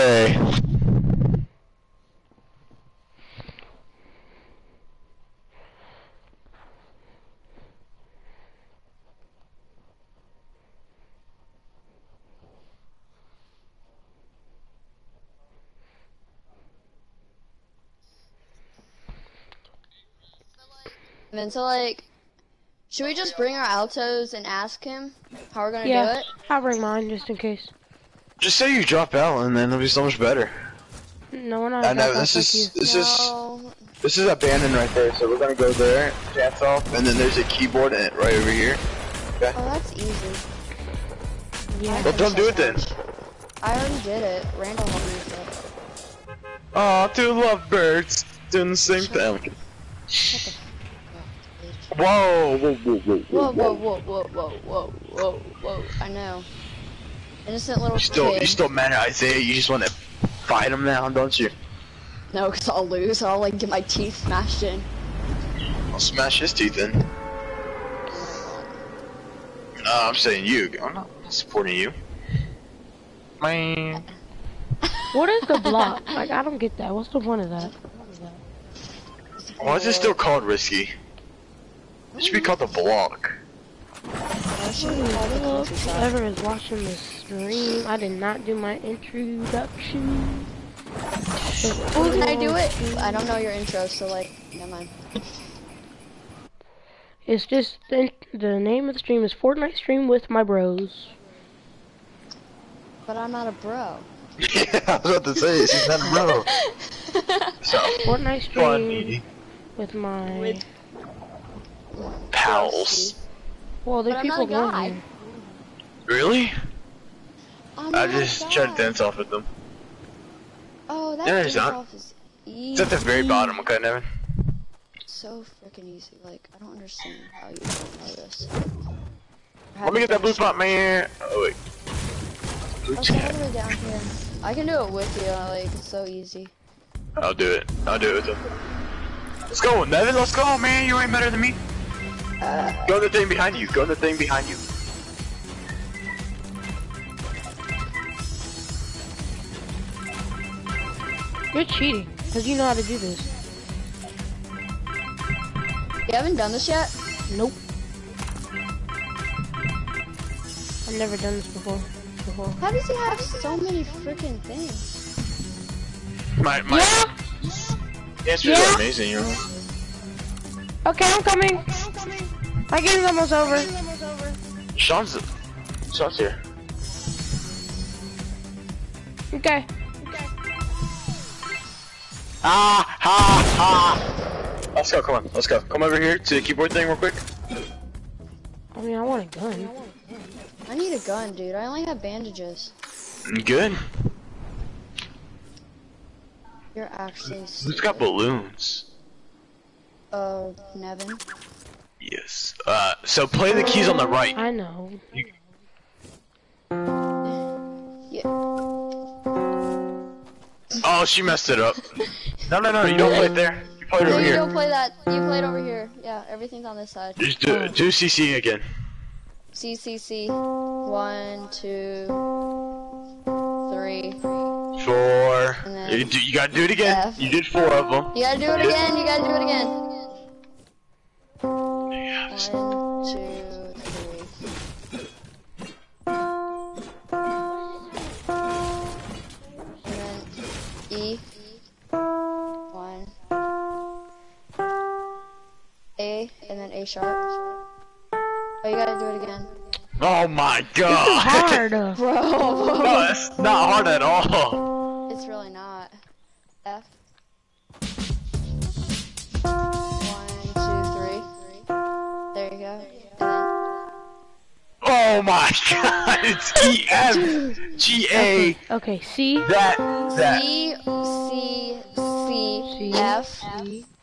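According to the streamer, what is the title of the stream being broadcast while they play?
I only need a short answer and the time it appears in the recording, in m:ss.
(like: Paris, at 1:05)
Fortnite Stream with my bros, at 1:39.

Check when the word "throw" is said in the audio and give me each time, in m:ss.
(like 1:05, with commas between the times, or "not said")
not said.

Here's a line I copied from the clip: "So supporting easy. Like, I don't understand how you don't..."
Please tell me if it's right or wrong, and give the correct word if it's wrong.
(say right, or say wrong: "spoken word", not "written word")
wrong: "freaking", not "supporting".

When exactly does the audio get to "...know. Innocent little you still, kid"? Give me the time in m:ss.
0:56.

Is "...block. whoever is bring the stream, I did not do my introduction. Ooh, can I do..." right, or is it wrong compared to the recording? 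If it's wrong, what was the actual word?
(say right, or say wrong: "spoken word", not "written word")
wrong: "watching", not "bring".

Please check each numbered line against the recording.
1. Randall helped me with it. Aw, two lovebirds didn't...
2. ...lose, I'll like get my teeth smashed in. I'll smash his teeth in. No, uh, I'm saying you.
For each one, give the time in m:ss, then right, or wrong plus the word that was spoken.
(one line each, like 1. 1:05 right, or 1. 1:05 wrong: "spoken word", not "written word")
1. 0:44 right
2. 1:02 right.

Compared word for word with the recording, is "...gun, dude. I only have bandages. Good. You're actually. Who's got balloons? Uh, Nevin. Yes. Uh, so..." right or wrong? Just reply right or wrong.
right.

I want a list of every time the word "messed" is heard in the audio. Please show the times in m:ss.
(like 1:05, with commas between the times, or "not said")
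3:31.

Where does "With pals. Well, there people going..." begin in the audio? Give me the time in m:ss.
1:50.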